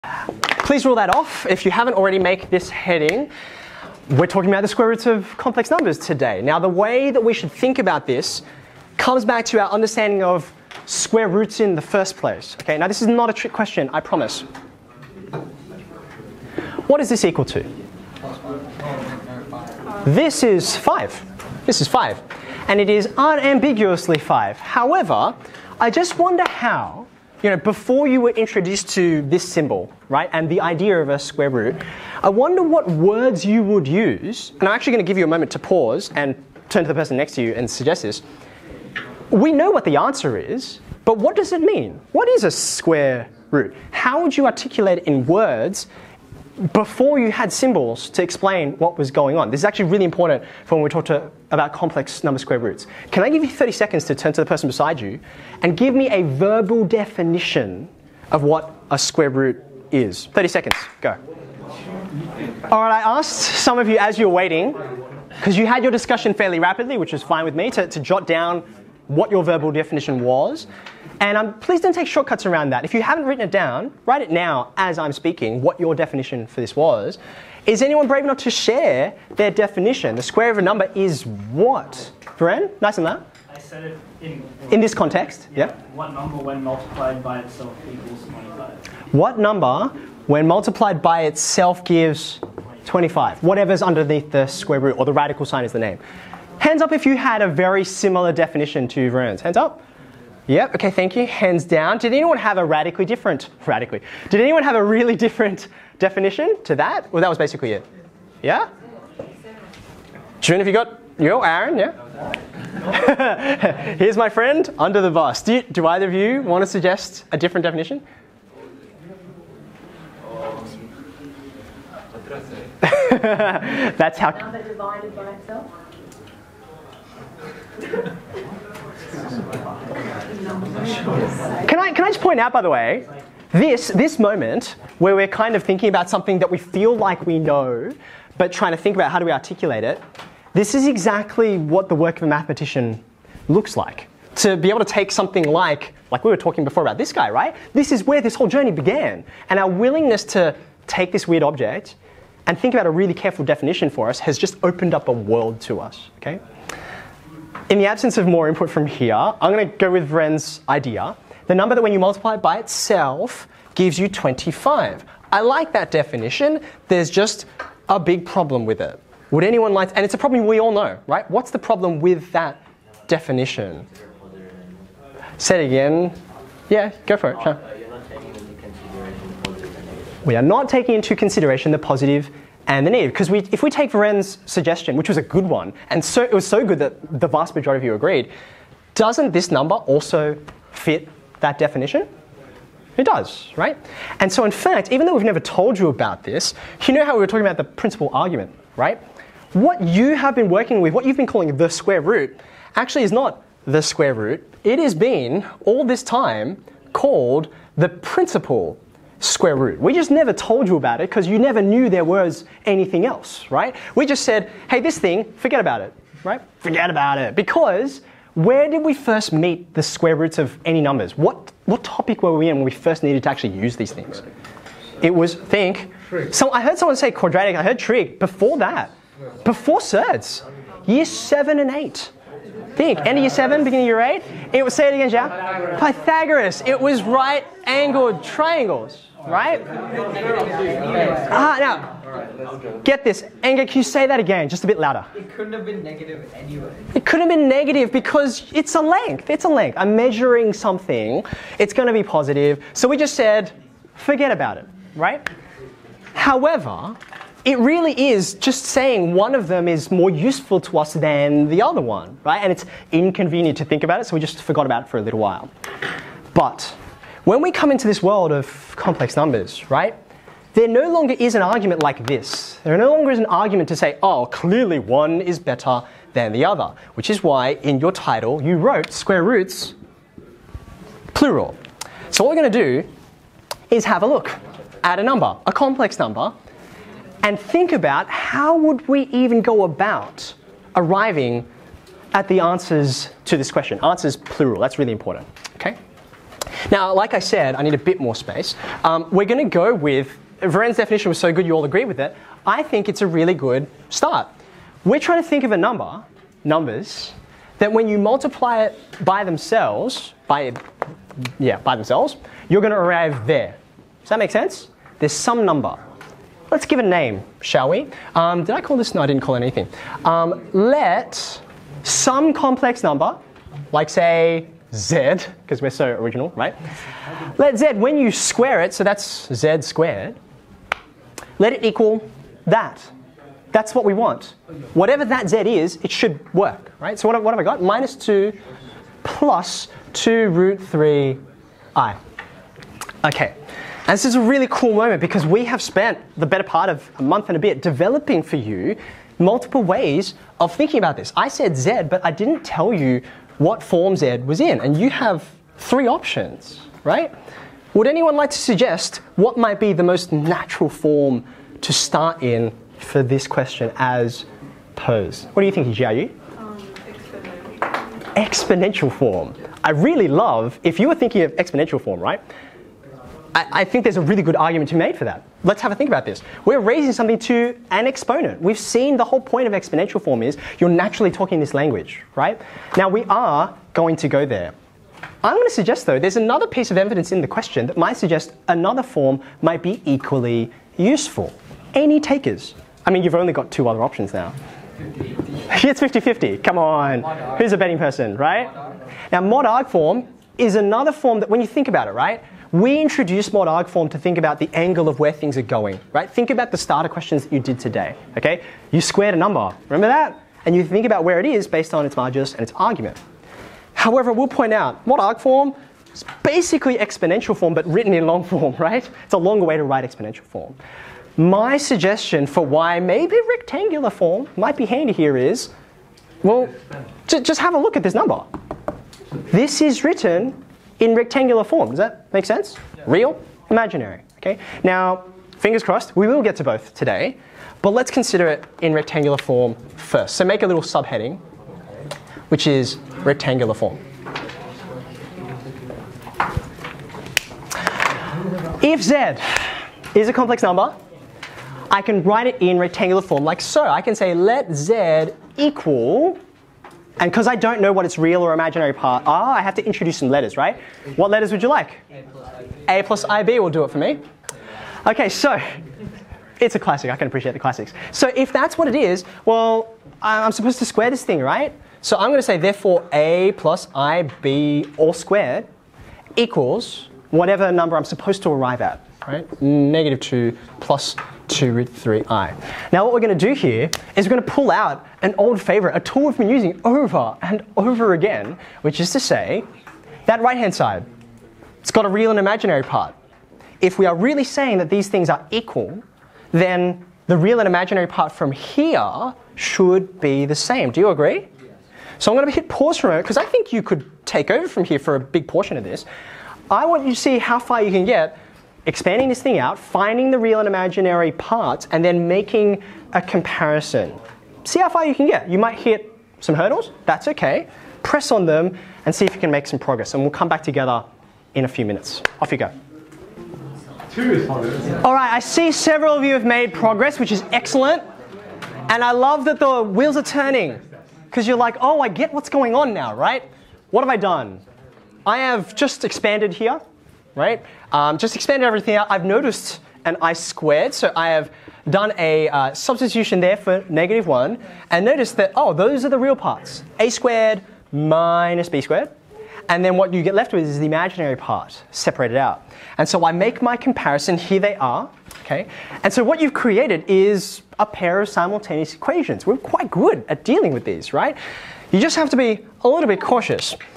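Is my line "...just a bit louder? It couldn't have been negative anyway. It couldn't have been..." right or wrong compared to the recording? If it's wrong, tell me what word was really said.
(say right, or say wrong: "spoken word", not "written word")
right.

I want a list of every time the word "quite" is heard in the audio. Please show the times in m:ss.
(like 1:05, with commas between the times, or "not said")
9:19.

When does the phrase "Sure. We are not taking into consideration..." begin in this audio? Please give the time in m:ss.
2:57.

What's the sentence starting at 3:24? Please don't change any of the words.
It has been, all this time, called the principal square root.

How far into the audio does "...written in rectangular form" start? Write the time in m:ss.
7:09.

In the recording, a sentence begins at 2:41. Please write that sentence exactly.
The number that when you multiply it by itself gives you 25.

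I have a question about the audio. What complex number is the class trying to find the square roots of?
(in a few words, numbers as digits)
-2 + 2√3 i.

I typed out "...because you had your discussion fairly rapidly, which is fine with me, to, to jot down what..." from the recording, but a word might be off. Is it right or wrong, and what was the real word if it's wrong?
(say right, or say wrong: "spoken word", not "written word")
right.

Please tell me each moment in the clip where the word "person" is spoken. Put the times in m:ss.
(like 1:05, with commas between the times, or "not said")
0:36, 0:54, 6:37.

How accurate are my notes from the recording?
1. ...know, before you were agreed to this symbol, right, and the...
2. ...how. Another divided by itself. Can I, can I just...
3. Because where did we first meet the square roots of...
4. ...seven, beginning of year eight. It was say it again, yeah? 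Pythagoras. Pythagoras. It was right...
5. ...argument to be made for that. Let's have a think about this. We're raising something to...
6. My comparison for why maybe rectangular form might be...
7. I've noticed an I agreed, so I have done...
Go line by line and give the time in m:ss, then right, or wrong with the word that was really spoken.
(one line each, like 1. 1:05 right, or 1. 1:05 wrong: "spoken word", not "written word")
1. 0:27 wrong: "introduced", not "agreed"
2. 2:04 right
3. 3:37 right
4. 3:53 right
5. 6:14 right
6. 7:01 wrong: "suggestion", not "comparison"
7. 8:58 wrong: "squared", not "agreed".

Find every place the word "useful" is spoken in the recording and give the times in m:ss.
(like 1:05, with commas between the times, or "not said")
4:20, 6:30.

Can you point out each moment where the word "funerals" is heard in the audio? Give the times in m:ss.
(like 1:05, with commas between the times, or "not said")
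not said.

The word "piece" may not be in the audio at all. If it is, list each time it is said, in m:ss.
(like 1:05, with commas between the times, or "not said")
6:26.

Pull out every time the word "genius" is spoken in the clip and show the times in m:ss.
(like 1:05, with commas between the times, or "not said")
not said.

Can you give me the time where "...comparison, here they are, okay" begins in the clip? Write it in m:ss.
9:13.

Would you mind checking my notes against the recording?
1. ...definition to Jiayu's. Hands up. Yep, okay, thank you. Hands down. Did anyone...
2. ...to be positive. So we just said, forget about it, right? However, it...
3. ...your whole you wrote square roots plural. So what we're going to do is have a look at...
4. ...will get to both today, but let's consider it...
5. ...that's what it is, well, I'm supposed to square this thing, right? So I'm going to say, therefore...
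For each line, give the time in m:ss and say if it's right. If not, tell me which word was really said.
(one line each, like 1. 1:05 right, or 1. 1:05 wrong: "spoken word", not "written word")
1. 1:38 wrong: "Vern", not "Jiayu"
2. 4:11 right
3. 4:37 wrong: "title", not "whole"
4. 7:16 right
5. 7:48 right.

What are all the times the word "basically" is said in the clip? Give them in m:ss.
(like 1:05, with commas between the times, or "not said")
1:47, 6:56.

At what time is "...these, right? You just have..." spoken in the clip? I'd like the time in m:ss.
9:20.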